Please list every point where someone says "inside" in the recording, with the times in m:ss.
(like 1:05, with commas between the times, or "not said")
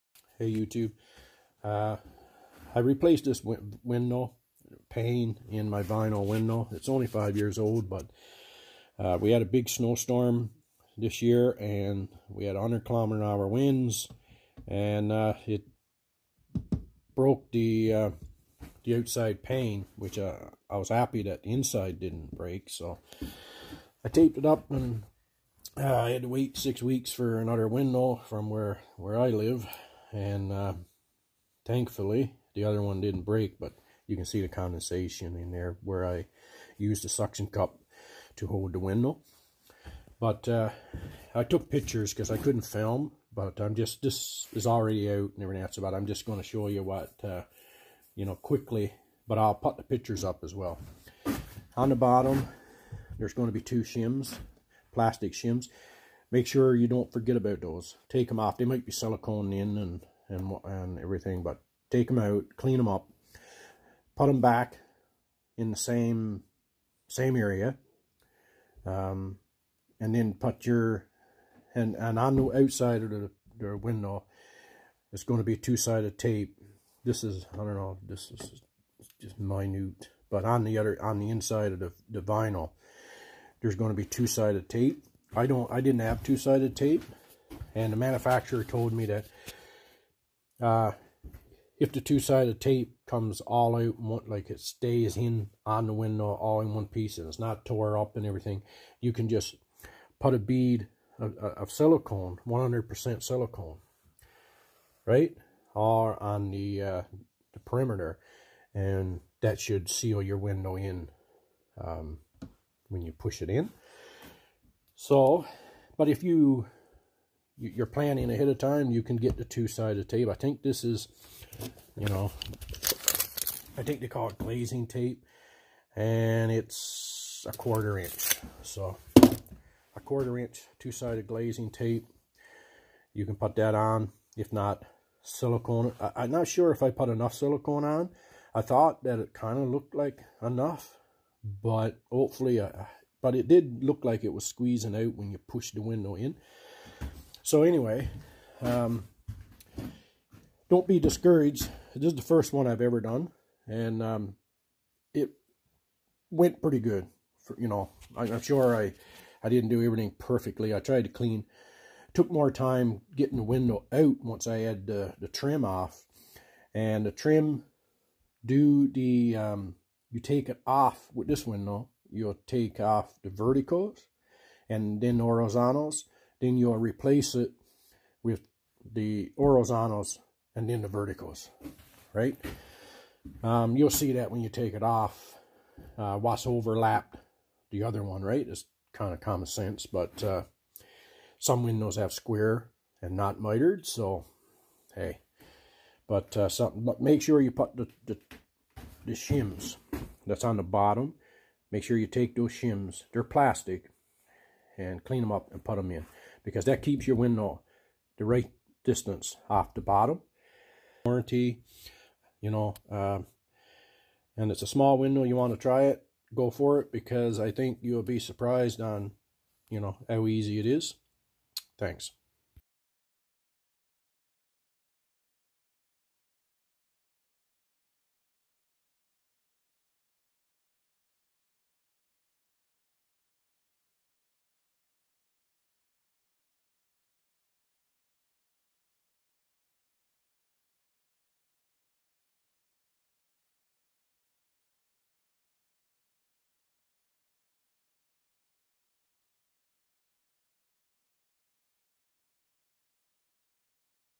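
0:21, 1:21.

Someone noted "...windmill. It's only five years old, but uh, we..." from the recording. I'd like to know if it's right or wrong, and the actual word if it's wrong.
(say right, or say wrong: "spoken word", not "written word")
right.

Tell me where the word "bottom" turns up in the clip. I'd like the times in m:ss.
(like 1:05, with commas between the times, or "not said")
0:51, 3:20, 3:29.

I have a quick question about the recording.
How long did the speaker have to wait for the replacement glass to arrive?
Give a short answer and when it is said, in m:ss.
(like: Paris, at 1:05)
6 weeks, at 0:26.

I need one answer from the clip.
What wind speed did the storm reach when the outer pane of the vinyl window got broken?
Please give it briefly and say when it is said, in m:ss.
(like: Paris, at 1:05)
100 km/h, at 0:12.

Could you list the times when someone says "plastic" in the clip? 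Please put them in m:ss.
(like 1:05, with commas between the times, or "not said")
0:54, 3:23.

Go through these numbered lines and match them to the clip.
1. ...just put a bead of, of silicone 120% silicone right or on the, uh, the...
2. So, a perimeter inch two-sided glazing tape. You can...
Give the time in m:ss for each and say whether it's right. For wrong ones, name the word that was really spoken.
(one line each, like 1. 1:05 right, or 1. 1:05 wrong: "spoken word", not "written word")
1. 1:39 wrong: "100", not "120"
2. 2:08 wrong: "quarter", not "perimeter".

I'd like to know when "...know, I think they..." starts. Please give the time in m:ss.
2:02.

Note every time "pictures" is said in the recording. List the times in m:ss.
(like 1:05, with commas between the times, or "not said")
0:41, 0:49.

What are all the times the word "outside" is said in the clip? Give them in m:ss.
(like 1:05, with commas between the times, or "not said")
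0:18, 1:12.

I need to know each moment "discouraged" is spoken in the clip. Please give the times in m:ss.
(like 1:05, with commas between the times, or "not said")
2:30.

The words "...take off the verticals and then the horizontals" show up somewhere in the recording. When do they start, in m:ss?
2:52.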